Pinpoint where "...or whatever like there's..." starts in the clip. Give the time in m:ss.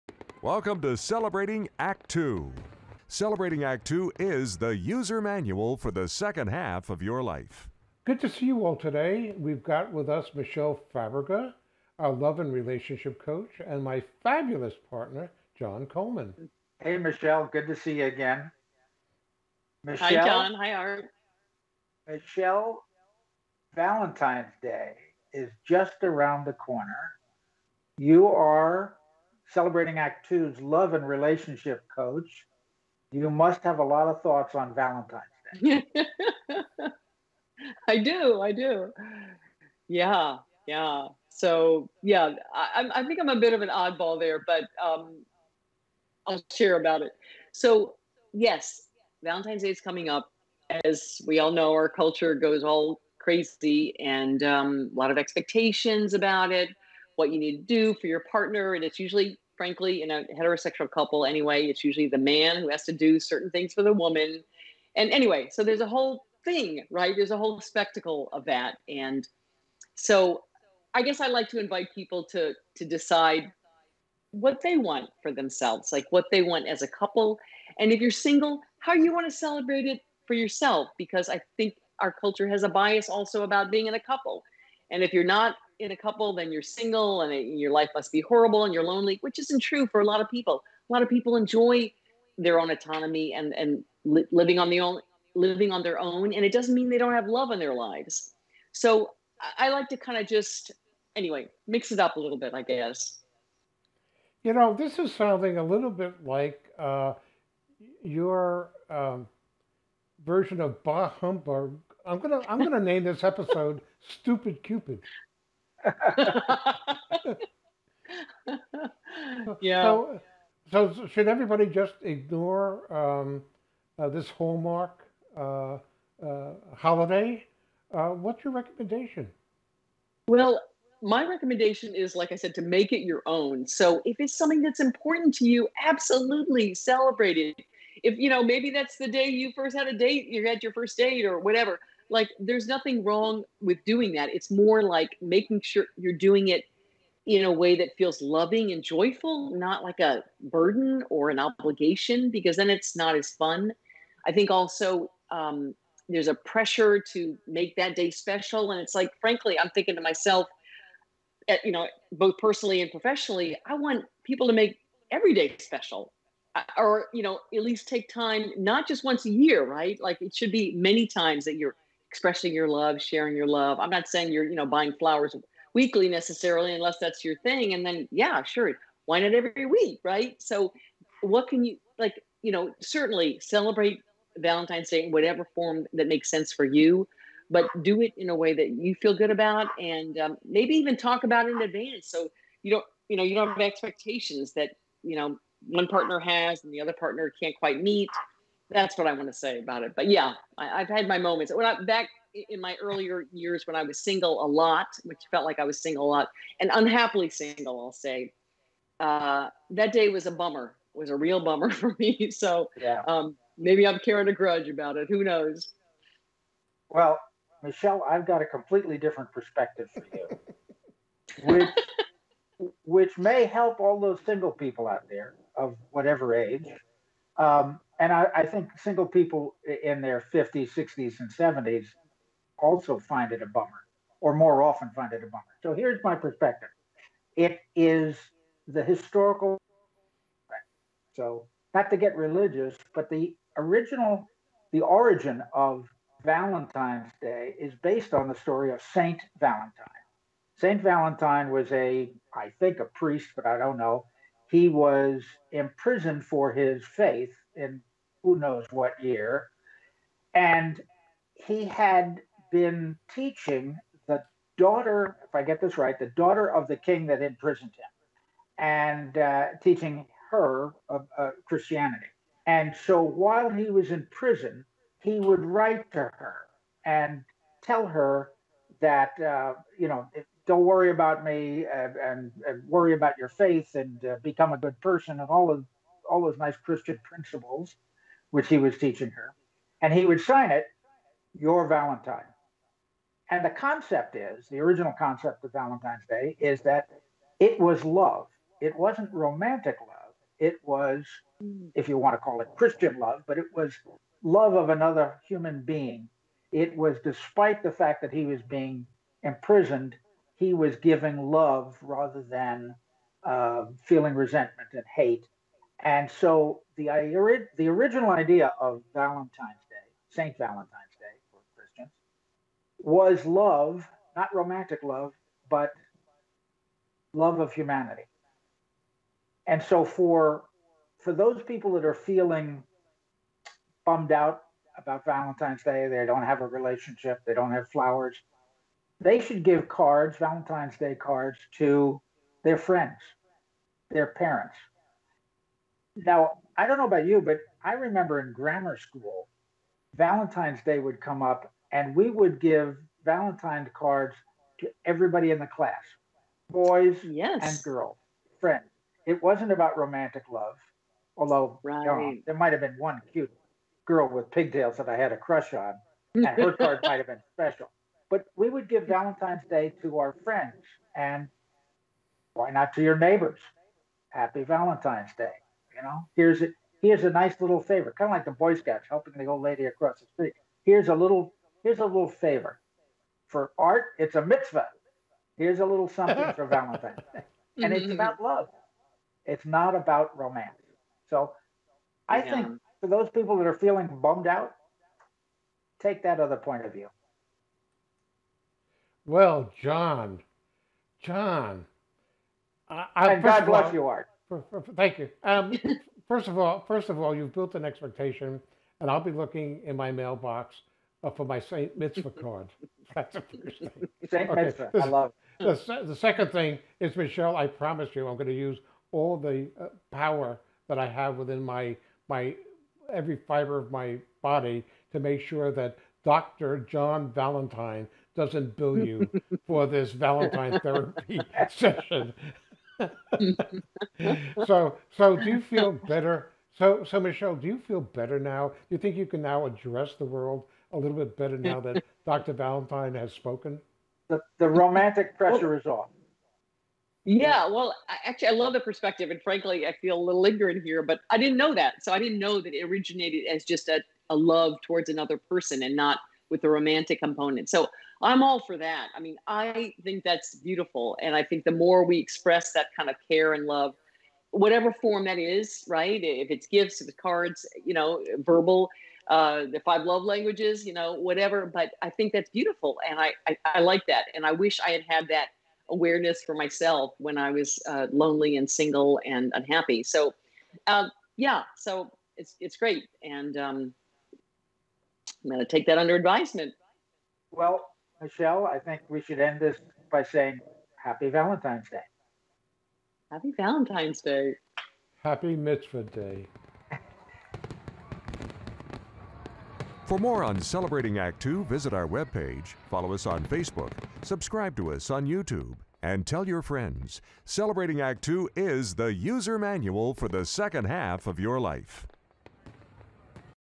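2:21.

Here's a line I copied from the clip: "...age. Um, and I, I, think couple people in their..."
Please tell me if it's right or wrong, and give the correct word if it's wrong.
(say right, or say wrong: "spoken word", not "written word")
wrong: "single", not "couple".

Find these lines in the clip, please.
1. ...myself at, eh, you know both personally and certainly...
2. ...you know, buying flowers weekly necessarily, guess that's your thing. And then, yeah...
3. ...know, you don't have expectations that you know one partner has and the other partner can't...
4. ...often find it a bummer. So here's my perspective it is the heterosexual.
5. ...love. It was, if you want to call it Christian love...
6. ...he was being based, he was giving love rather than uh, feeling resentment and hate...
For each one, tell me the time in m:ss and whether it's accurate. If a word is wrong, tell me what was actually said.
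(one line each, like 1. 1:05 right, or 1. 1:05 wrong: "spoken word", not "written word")
1. 2:40 wrong: "professionally", not "certainly"
2. 2:54 wrong: "unless", not "guess"
3. 3:13 right
4. 3:54 wrong: "historical", not "heterosexual"
5. 4:59 right
6. 5:08 wrong: "imprisoned", not "based".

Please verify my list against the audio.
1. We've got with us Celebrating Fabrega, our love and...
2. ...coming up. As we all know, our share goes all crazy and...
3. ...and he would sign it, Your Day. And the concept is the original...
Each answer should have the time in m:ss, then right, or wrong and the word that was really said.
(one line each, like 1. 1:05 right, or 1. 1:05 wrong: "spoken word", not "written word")
1. 0:09 wrong: "Michele", not "Celebrating"
2. 0:49 wrong: "culture", not "share"
3. 4:49 wrong: "Valentine", not "Day".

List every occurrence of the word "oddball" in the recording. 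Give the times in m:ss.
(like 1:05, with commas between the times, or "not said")
0:43.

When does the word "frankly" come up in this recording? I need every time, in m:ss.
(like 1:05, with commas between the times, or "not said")
0:59, 2:39, 7:29.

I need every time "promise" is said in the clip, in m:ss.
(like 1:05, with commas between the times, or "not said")
6:57.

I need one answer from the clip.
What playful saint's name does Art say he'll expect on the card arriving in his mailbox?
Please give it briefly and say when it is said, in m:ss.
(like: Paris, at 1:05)
Saint Mitzvah, at 6:51.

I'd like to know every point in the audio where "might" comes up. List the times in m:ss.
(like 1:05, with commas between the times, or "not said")
6:02, 6:06.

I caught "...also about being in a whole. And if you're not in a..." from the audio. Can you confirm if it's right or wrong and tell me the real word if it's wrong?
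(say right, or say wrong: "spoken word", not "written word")
wrong: "couple", not "whole".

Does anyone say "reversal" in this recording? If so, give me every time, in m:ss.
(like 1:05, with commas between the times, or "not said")
not said.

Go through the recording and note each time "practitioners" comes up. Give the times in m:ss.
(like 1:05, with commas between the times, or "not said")
not said.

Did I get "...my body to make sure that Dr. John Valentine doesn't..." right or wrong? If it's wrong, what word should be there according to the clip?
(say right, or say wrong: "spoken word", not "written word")
right.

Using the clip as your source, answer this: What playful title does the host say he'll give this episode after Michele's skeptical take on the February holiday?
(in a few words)
Stupid Cupid.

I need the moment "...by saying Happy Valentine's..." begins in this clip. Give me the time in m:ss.
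8:09.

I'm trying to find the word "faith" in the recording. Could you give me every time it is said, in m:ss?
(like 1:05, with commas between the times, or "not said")
4:16, 4:43.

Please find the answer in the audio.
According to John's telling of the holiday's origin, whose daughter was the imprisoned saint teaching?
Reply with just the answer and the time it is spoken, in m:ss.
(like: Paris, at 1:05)
The king's, at 4:25.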